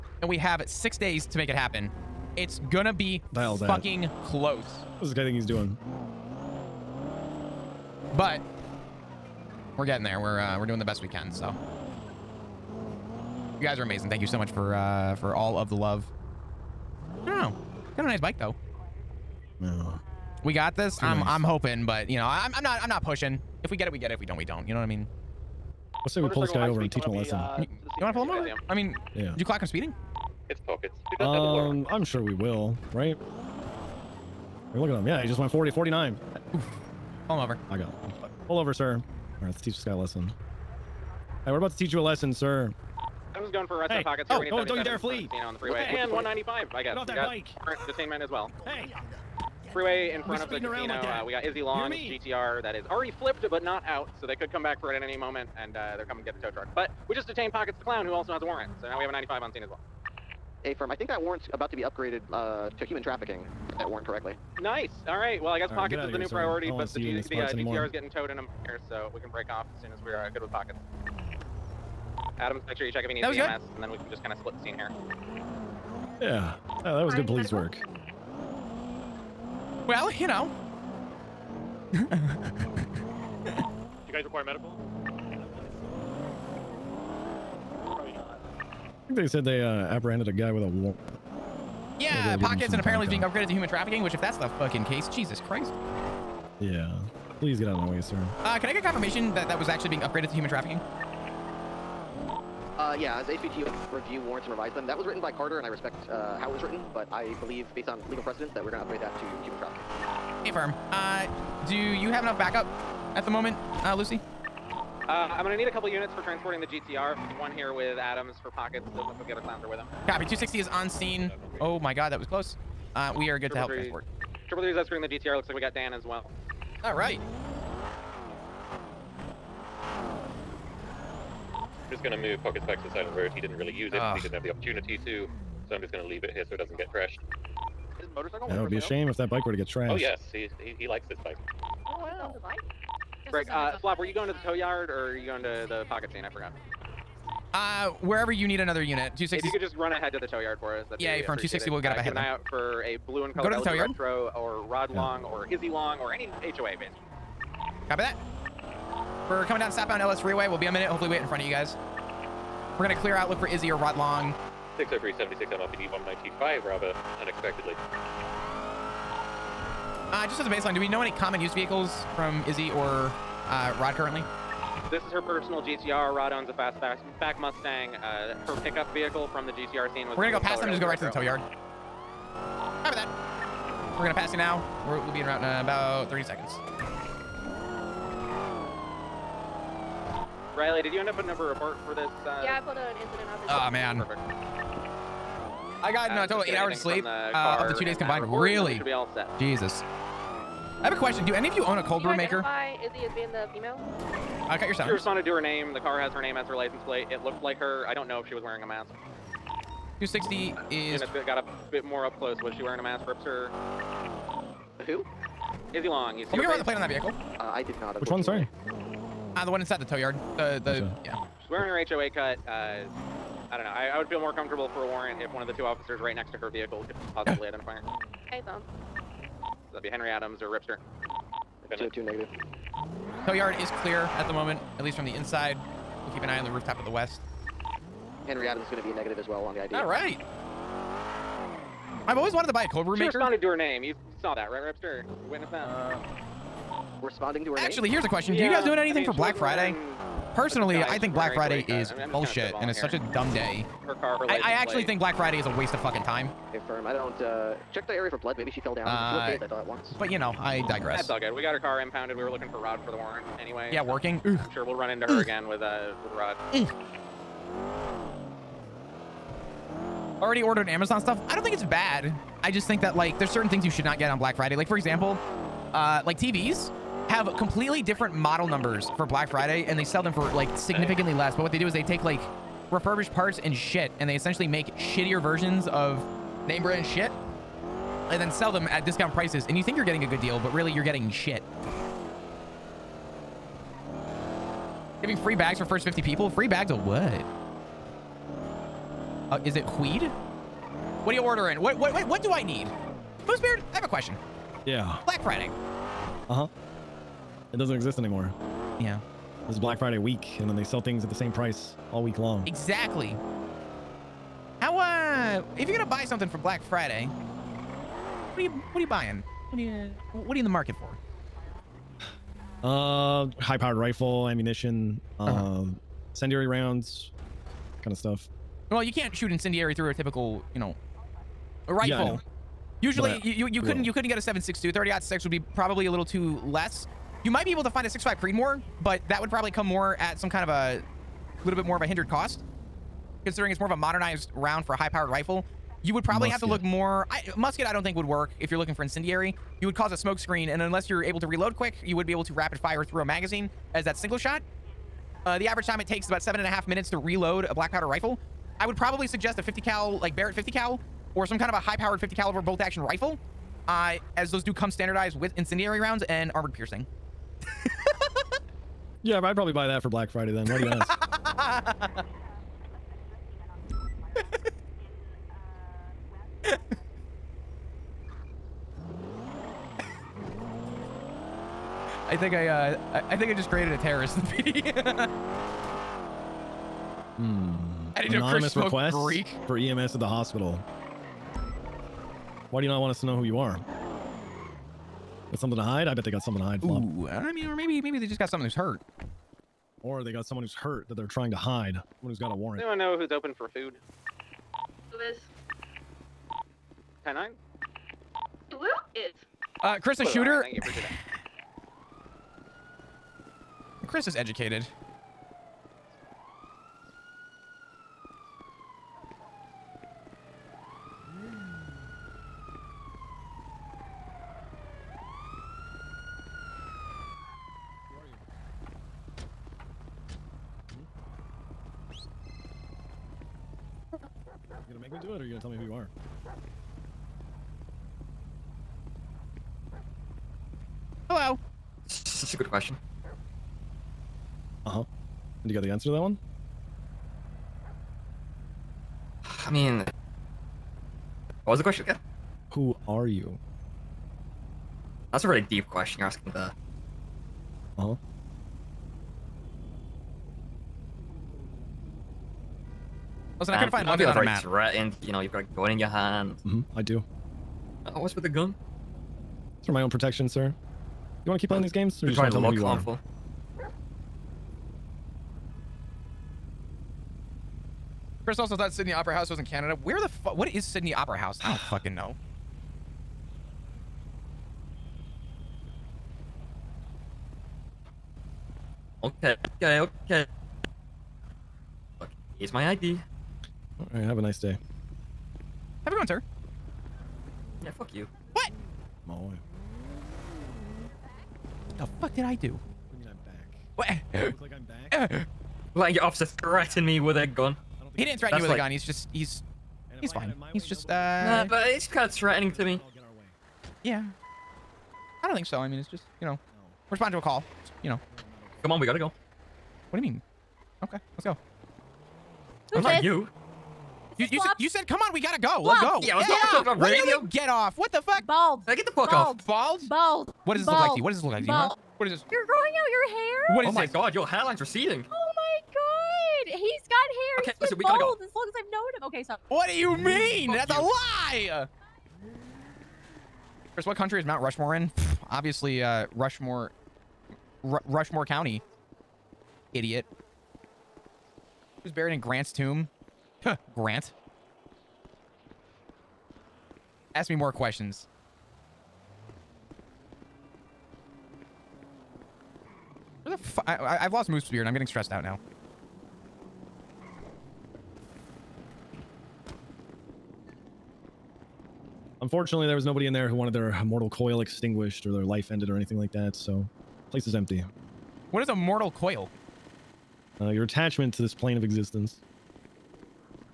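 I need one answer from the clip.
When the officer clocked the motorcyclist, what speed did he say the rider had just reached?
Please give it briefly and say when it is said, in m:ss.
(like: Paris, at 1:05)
49, at 0:35.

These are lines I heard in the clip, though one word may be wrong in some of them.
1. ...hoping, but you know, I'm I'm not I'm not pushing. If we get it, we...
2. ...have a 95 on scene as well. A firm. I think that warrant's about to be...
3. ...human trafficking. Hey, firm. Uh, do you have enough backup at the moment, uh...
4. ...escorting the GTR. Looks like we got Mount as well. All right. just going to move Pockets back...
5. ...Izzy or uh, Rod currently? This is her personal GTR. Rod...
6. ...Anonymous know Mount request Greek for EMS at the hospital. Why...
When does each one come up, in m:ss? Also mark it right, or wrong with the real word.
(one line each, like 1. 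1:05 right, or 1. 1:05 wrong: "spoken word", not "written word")
1. 0:21 right
2. 0:59 right
3. 1:49 right
4. 2:04 wrong: "Dan", not "Mount"
5. 2:52 right
6. 6:28 wrong: "Chris", not "Mount".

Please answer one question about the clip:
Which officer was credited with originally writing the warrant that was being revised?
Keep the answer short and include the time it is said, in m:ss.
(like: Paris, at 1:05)
Carter, at 1:45.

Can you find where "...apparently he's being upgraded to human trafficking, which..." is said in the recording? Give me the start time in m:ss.
1:32.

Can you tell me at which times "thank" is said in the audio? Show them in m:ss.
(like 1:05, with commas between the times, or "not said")
0:14, 6:50.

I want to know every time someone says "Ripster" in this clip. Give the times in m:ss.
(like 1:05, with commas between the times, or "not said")
3:33, 3:50.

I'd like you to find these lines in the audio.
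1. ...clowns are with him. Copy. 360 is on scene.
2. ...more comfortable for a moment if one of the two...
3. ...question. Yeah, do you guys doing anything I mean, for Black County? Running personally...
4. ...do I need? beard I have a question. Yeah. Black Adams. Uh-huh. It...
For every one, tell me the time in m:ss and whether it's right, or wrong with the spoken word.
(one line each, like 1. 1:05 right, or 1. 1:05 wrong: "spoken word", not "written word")
1. 1:59 wrong: "260", not "360"
2. 3:44 wrong: "warrant", not "moment"
3. 4:08 wrong: "Friday", not "County"
4. 5:02 wrong: "Friday", not "Adams".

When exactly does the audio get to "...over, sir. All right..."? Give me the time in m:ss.
0:38.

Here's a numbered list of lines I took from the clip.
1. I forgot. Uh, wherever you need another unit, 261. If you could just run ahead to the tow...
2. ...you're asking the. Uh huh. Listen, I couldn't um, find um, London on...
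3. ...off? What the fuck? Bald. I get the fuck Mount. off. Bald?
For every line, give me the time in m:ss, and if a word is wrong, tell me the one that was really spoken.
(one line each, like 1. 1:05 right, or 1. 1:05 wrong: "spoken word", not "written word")
1. 2:26 wrong: "260", not "261"
2. 7:35 right
3. 8:47 wrong: "Bald", not "Mount".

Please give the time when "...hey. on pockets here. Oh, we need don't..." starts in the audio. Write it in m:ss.
0:43.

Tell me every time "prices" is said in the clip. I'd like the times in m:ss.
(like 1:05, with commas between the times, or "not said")
4:49, 5:11.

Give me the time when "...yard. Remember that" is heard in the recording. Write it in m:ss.
3:01.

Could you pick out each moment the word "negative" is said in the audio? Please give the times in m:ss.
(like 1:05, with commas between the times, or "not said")
3:52, 3:58.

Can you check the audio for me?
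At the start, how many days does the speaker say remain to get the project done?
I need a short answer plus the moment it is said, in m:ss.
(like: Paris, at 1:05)
6, at 0:00.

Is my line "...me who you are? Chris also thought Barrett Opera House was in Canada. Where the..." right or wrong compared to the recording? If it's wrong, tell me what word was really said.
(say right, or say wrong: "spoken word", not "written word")
wrong: "Sydney", not "Barrett".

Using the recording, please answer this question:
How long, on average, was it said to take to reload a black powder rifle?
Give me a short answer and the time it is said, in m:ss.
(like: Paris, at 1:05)
7.5 minutes, at 5:56.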